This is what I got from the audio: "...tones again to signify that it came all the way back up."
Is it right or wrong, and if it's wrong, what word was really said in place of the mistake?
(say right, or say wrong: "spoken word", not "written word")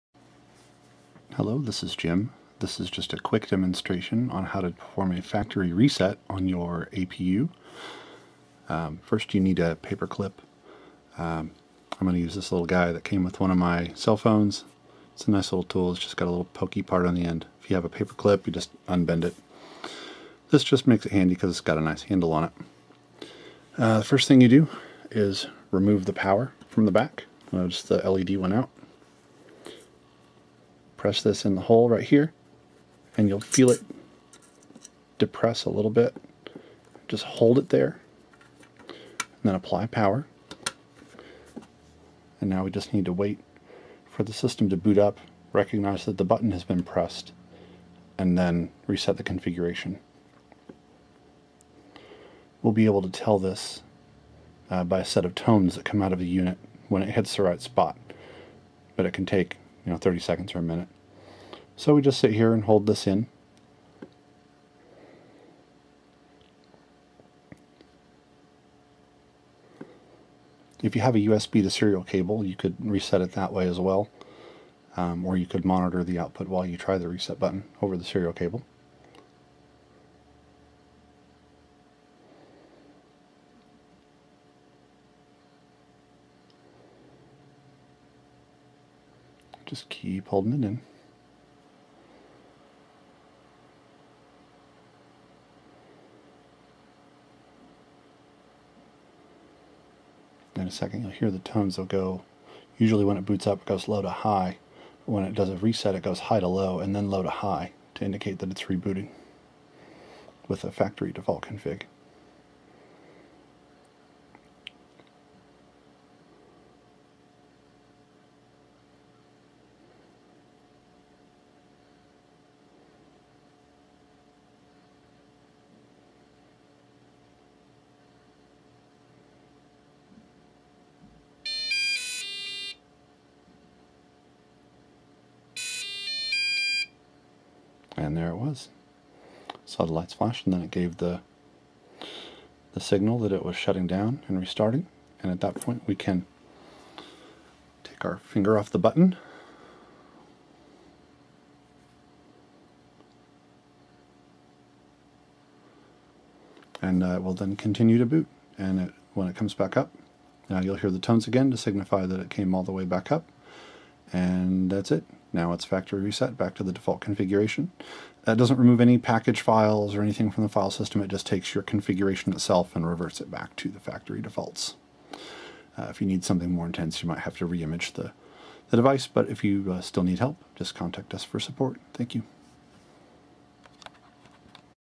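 right.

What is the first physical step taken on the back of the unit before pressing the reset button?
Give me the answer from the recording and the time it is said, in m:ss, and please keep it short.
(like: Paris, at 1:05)
remove the power, at 0:25.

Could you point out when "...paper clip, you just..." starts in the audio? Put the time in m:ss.
0:17.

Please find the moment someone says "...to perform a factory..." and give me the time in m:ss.
0:04.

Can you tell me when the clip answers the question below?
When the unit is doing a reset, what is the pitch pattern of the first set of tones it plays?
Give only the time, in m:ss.
1:46.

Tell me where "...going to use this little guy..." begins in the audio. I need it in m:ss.
0:12.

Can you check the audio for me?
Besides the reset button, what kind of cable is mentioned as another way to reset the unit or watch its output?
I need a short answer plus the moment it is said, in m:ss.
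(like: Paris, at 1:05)
USB to serial cable, at 1:11.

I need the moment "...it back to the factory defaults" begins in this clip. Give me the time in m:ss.
2:53.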